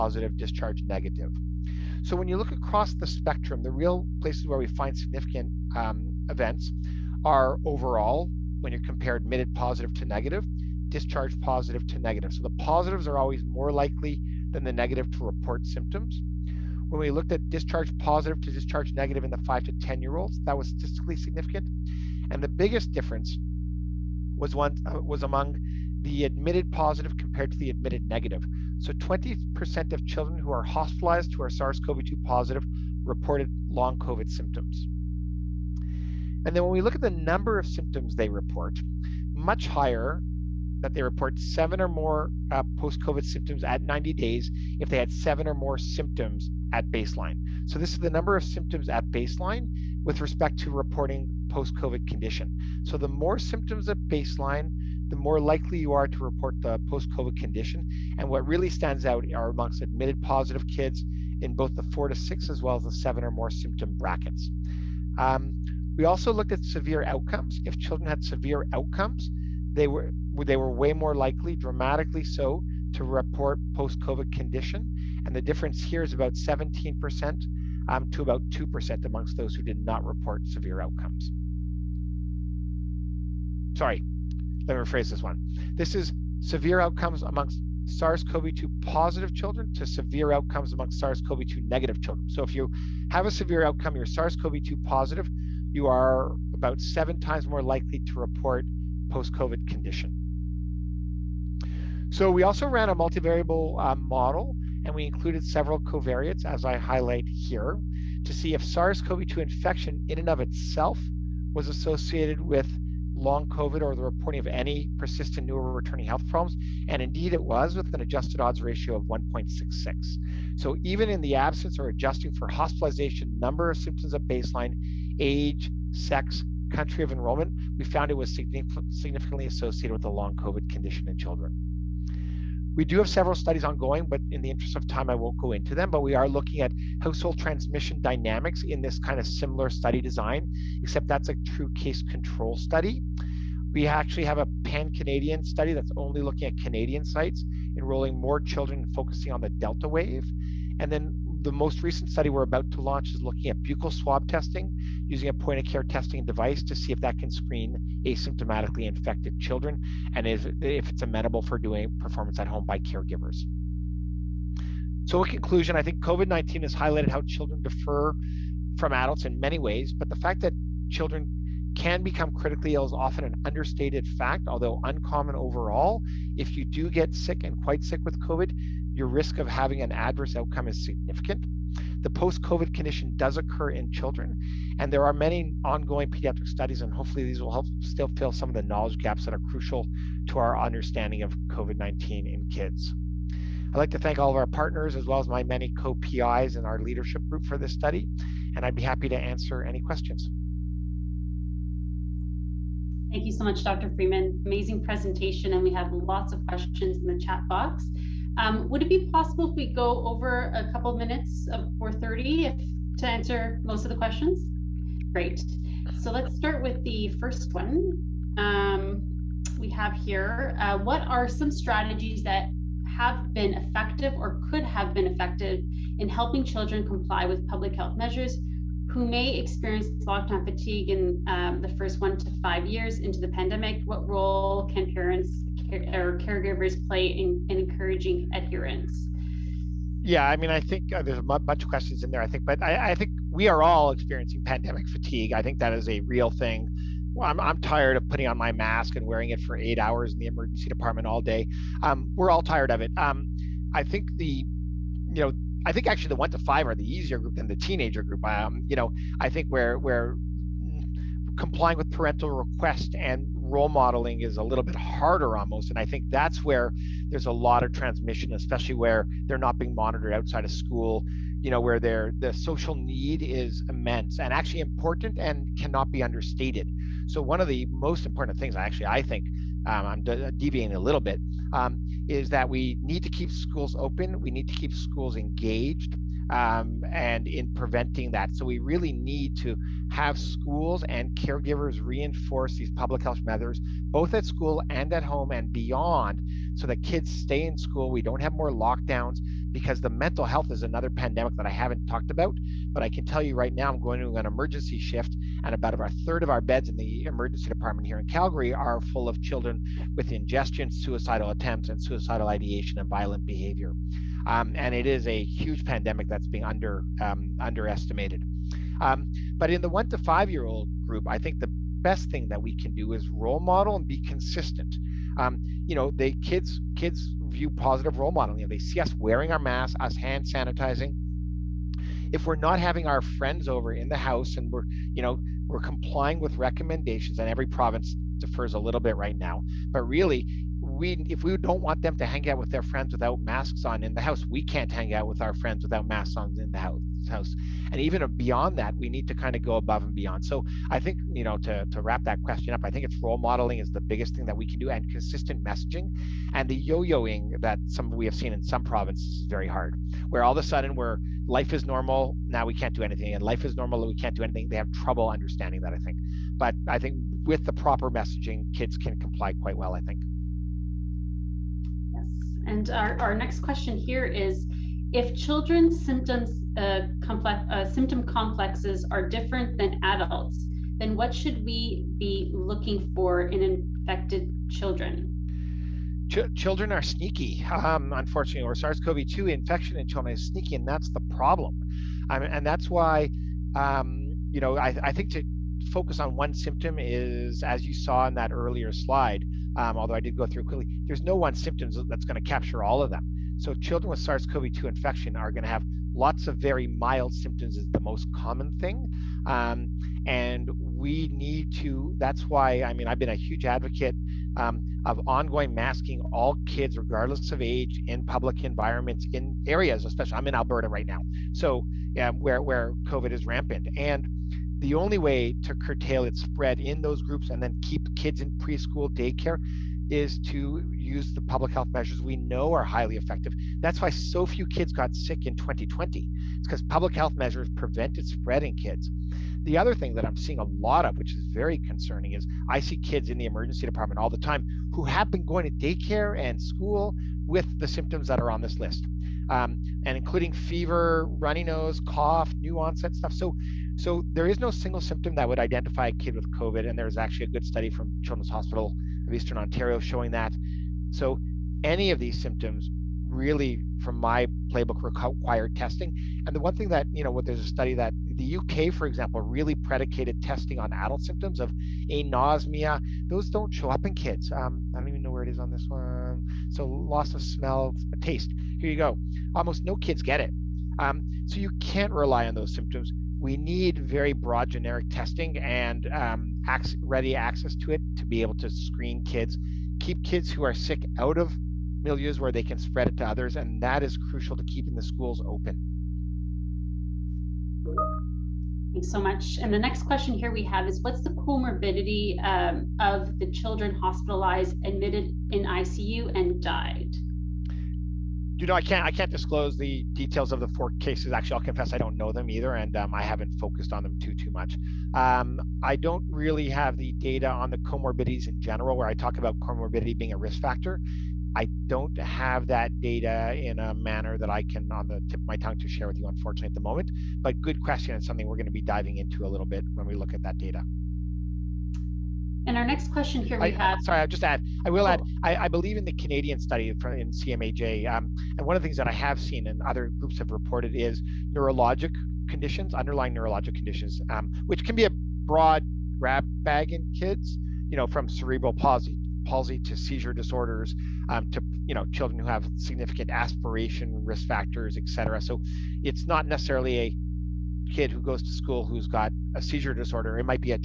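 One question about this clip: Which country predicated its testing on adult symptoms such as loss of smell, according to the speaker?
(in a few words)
UK.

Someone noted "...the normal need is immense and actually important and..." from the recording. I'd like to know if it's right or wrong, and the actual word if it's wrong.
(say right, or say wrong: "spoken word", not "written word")
wrong: "social", not "normal".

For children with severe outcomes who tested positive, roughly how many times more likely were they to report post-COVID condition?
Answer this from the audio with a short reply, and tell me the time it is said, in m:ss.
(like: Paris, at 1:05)
7, at 1:36.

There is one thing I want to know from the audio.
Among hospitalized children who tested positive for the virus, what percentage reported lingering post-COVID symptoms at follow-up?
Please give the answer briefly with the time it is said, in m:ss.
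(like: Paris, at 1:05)
20%, at 0:28.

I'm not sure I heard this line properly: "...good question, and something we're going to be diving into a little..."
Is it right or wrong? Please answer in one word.
right.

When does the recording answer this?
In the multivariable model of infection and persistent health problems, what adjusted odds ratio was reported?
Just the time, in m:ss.
1:59.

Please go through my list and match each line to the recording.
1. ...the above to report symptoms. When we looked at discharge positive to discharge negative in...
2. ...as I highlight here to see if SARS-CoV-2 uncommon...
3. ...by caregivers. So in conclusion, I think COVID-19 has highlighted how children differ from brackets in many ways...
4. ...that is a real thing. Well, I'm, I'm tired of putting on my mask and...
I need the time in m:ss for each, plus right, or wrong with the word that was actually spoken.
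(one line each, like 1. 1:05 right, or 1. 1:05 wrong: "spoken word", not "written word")
1. 0:14 wrong: "negative", not "above"
2. 1:46 wrong: "infection", not "uncommon"
3. 2:42 wrong: "adults", not "brackets"
4. 4:05 right.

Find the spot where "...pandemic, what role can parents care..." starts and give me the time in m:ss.
3:53.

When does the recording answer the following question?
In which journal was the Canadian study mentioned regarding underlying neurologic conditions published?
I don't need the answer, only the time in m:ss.
8:56.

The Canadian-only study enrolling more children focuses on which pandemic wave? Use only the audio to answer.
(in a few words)
Delta wave.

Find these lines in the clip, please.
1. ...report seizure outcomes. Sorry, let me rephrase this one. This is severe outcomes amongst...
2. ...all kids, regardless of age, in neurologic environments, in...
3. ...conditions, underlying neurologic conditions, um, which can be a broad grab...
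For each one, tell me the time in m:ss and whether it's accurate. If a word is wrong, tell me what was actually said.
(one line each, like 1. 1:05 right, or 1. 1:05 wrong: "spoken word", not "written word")
1. 1:20 wrong: "severe", not "seizure"
2. 6:56 wrong: "public", not "neurologic"
3. 9:02 right.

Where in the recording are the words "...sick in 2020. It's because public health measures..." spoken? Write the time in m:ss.
7:14.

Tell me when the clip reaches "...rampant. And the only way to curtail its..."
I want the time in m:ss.
7:03.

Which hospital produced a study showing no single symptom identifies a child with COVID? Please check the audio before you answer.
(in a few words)
Children's Hospital of Eastern Ontario.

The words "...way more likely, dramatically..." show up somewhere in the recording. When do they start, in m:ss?
1:10.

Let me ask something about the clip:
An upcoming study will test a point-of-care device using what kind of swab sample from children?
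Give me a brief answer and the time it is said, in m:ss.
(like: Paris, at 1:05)
buccal swab, at 2:33.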